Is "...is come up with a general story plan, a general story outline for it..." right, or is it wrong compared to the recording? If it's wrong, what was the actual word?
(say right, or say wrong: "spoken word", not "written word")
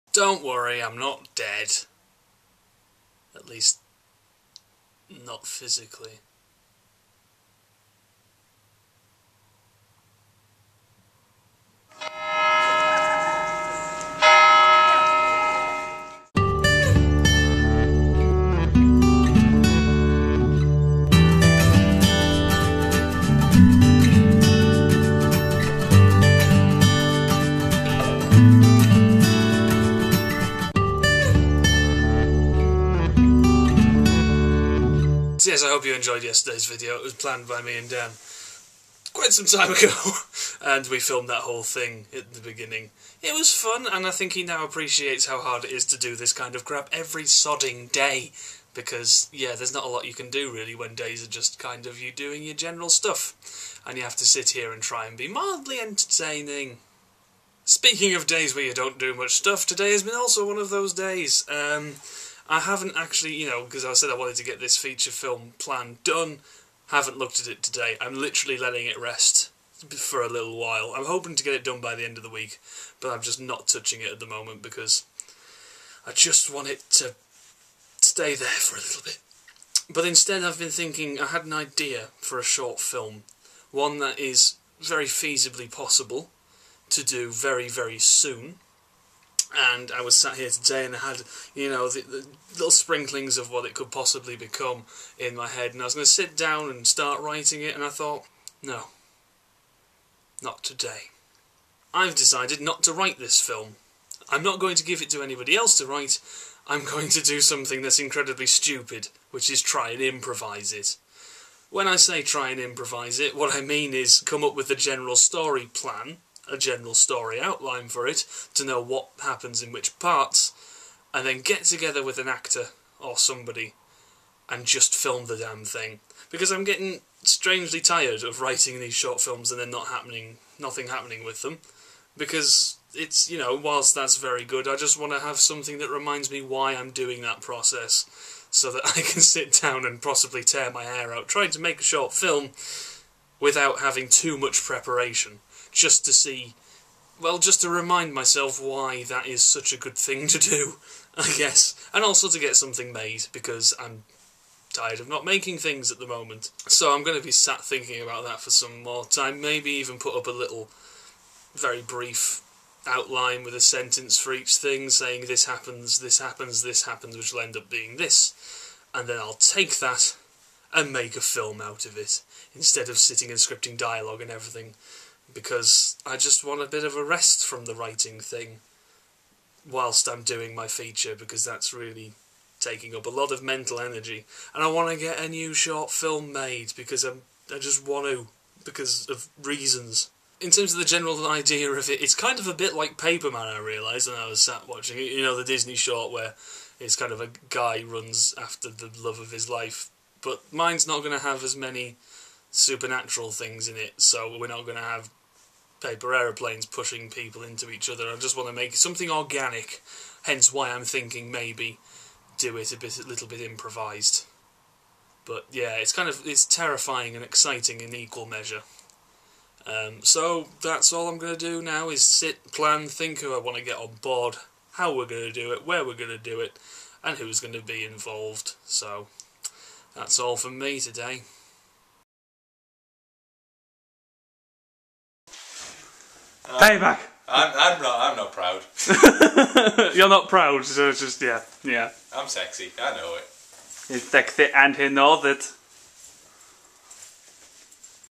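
right.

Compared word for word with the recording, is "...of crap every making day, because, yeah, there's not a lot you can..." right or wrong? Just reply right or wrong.
wrong.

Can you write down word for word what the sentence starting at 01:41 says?
I've decided not to write this film.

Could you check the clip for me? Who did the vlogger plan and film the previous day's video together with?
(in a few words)
Dan.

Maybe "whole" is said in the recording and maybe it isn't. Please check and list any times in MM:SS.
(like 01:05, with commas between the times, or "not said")
00:41.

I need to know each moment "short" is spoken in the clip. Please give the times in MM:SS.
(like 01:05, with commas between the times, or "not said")
01:22, 02:08, 02:21, 03:05, 03:15.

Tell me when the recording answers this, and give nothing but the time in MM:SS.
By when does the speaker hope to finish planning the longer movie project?
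01:12.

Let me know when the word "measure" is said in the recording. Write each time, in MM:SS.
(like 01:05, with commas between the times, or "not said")
03:38.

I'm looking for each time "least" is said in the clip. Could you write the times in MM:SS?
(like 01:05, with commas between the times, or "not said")
00:03.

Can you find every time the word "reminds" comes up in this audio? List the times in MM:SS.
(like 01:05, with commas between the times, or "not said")
02:15, 02:27.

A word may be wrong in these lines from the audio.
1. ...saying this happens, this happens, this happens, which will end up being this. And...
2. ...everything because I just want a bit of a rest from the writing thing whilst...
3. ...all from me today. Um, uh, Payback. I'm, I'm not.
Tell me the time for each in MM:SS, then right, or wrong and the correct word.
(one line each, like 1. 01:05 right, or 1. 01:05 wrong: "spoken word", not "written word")
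1. 02:44 right
2. 02:54 right
3. 03:50 right.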